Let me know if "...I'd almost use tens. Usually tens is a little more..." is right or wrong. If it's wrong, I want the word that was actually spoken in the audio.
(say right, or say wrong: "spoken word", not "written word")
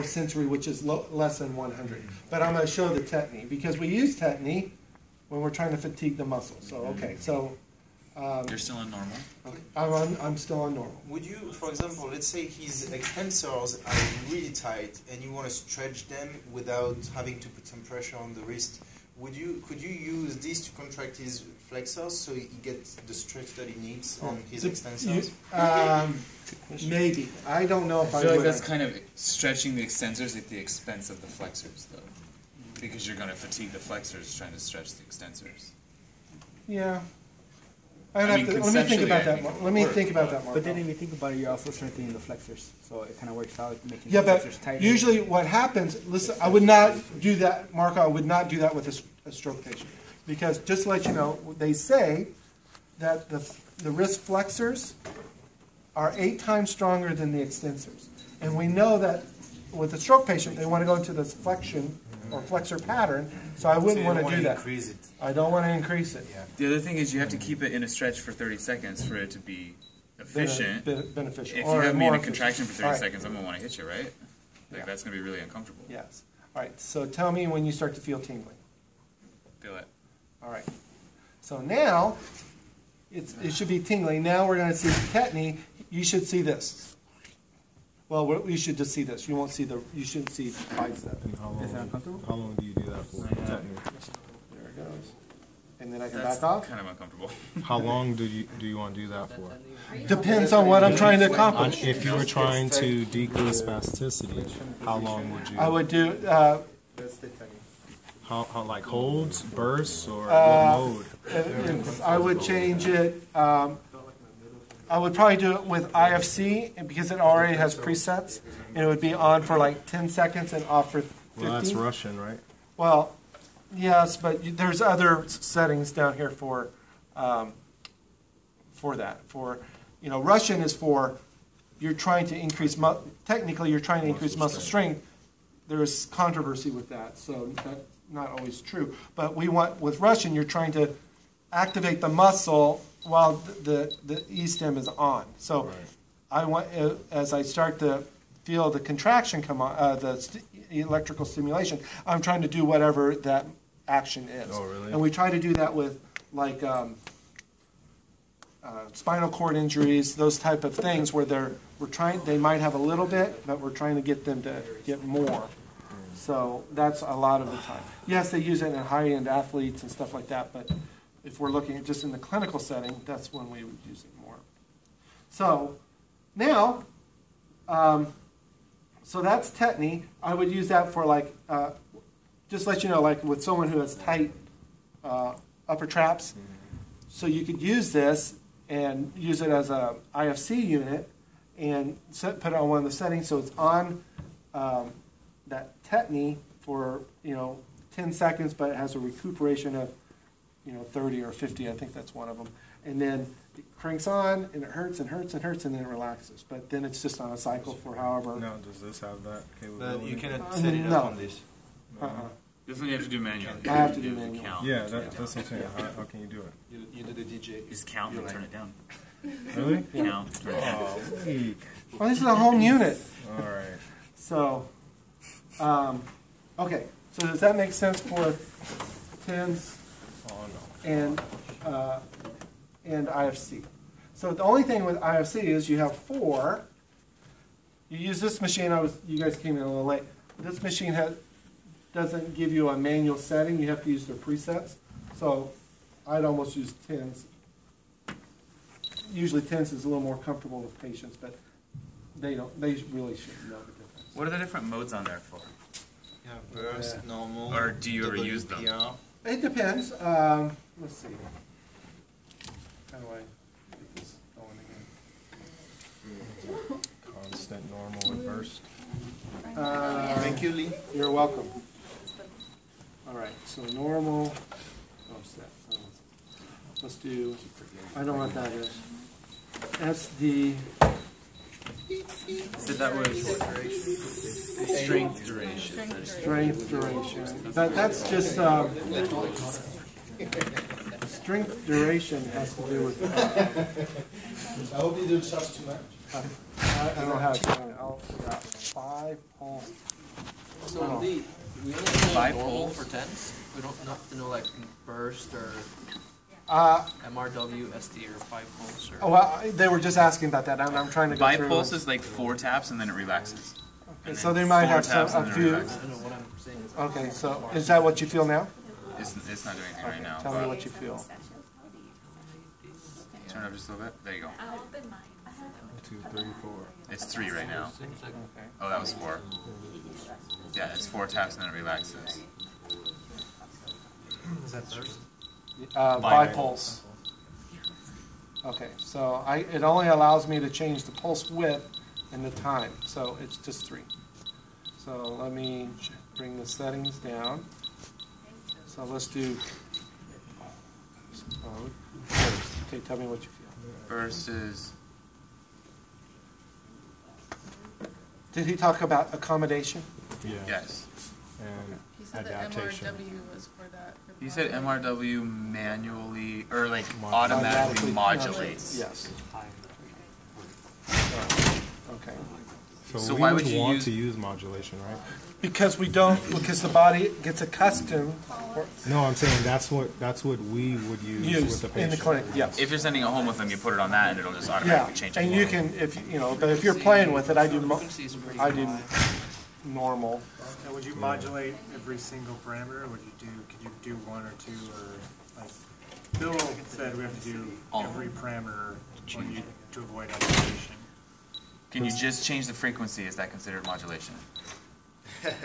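right.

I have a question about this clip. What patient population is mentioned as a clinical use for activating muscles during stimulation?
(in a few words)
spinal cord injuries.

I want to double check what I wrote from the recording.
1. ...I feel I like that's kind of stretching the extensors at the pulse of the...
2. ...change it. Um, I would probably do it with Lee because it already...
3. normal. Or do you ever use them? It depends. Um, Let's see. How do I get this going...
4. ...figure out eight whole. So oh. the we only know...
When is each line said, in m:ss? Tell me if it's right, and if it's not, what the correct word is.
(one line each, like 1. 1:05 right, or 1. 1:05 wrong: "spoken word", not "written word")
1. 0:28 wrong: "expense", not "pulse"
2. 1:52 wrong: "IFC", not "Lee"
3. 4:17 right
4. 4:57 wrong: "five", not "eight".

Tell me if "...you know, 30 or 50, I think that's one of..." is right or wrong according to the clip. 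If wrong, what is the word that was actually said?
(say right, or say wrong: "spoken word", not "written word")
right.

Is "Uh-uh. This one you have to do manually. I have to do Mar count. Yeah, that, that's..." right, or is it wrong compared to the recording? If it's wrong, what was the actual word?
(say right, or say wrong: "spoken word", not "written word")
wrong: "You", not "Mar".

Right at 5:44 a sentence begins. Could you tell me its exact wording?
So let me bring the settings down.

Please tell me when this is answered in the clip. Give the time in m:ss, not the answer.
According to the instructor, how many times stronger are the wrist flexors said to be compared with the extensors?
0:56.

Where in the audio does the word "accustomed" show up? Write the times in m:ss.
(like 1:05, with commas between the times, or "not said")
6:17.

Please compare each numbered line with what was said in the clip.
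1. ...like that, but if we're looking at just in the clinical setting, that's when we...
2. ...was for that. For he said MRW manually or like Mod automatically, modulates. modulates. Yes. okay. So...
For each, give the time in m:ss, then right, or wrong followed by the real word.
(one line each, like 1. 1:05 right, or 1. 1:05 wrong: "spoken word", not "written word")
1. 2:50 right
2. 6:03 right.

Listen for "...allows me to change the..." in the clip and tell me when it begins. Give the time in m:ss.
5:39.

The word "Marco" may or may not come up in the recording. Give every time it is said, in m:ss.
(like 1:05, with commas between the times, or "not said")
0:40, 0:47.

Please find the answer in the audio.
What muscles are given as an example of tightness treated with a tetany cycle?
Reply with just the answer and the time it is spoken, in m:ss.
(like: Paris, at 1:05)
upper traps, at 3:05.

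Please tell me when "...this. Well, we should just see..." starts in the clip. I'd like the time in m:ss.
1:26.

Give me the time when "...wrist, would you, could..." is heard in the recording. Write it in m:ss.
0:18.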